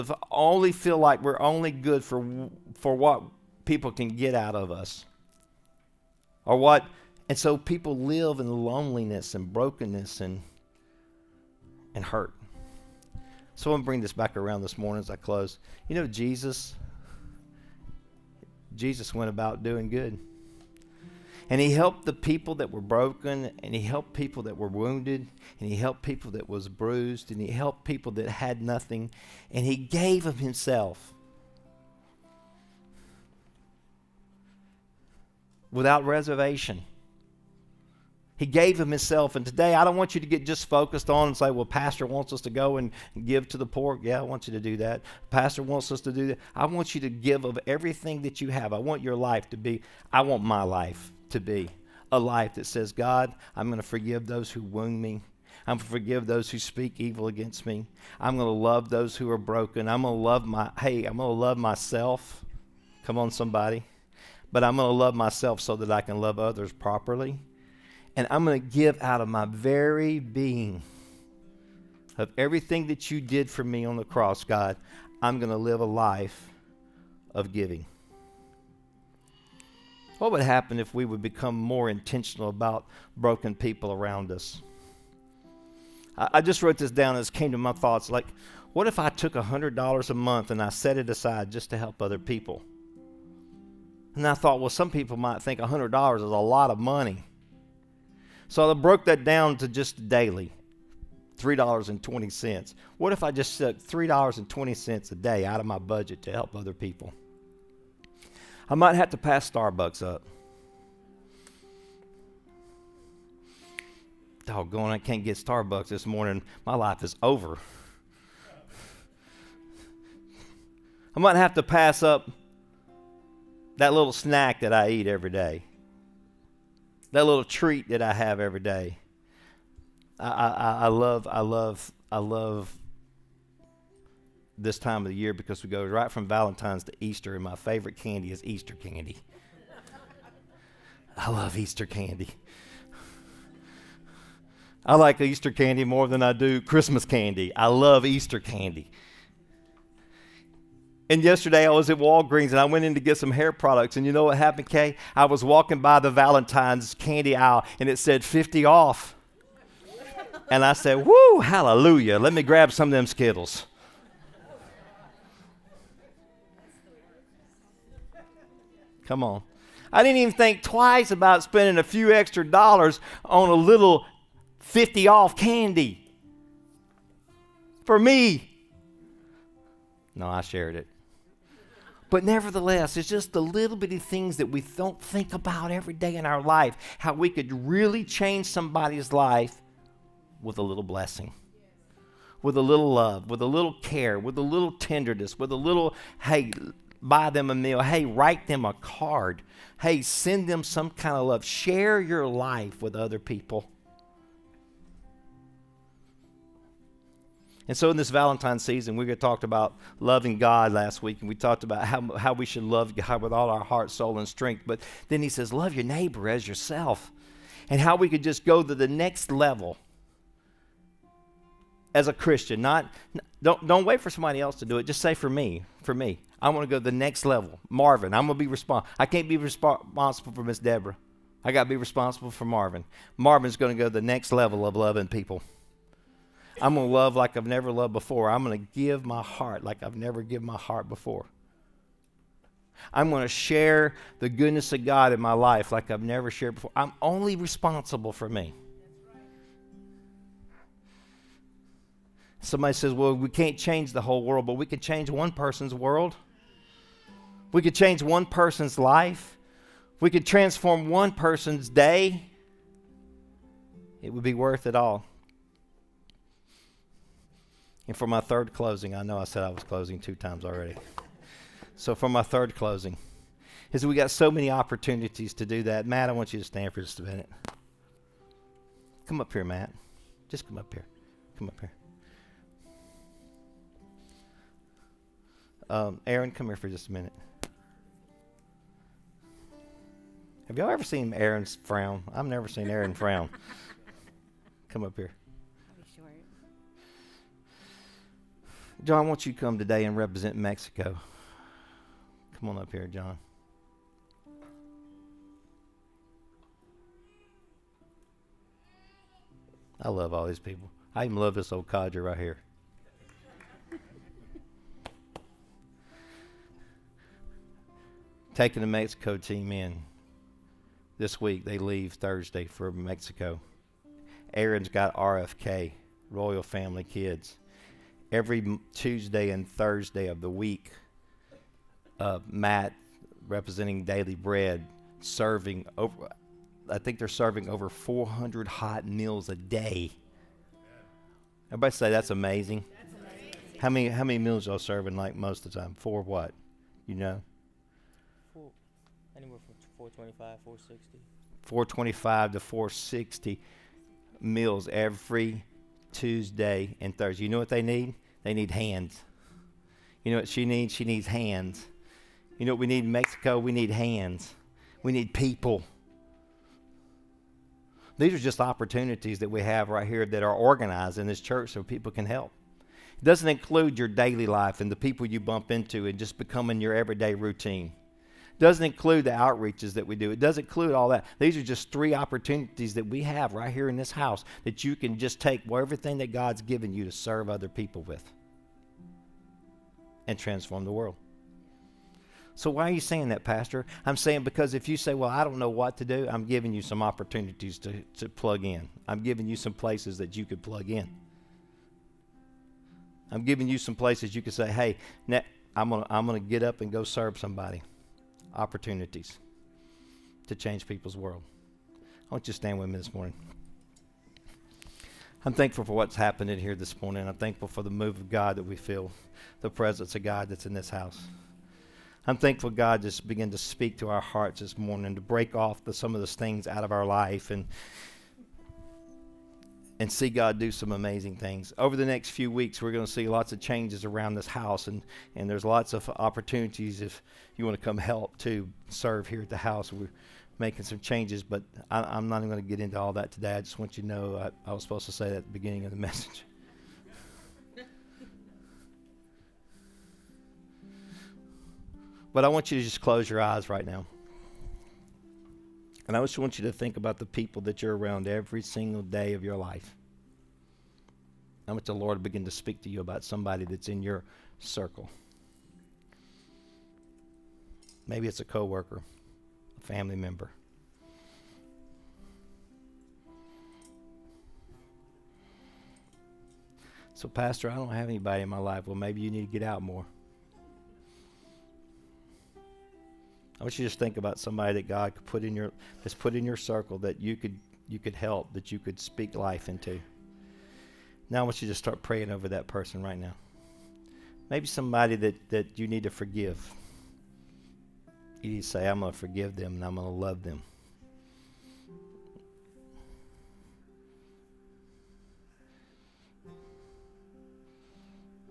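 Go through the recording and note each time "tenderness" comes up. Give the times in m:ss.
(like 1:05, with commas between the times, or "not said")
3:14.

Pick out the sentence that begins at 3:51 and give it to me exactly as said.
I gotta be responsible for Marvin.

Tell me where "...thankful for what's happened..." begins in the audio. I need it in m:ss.
6:55.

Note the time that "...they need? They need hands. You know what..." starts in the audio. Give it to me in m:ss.
5:57.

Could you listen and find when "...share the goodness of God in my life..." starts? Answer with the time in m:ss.
4:03.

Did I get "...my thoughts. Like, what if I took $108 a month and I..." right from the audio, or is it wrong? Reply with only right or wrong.
wrong.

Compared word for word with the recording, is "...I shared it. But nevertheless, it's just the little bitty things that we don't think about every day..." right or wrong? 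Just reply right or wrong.
right.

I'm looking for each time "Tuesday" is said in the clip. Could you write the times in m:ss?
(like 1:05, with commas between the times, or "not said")
5:28, 5:55.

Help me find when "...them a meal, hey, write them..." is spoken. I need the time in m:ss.
3:17.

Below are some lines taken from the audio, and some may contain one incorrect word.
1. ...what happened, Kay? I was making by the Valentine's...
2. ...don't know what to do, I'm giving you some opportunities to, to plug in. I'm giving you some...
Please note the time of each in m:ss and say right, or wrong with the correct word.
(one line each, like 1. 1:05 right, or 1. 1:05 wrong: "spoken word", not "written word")
1. 2:34 wrong: "walking", not "making"
2. 6:35 right.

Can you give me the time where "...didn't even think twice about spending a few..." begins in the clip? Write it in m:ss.
2:50.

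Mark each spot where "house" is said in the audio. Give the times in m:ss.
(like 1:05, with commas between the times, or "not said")
6:23, 7:00, 7:14, 7:19.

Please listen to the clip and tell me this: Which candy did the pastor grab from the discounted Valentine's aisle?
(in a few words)
Skittles.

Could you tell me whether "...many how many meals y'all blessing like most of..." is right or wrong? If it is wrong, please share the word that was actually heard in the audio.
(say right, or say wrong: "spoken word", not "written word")
wrong: "serving", not "blessing".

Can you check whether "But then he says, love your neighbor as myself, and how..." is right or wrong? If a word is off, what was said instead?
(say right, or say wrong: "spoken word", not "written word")
wrong: "yourself", not "myself".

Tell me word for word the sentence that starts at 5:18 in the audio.
Taking the Mexico team in this week.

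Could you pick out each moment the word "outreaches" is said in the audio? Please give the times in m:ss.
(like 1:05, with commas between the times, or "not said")
6:19.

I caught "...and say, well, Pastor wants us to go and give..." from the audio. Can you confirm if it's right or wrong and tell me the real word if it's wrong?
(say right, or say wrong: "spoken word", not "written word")
right.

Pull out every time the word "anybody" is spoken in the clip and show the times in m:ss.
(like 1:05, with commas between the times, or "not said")
7:57.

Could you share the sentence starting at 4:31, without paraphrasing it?
so for my third closing, is we got so many opportunities to do that.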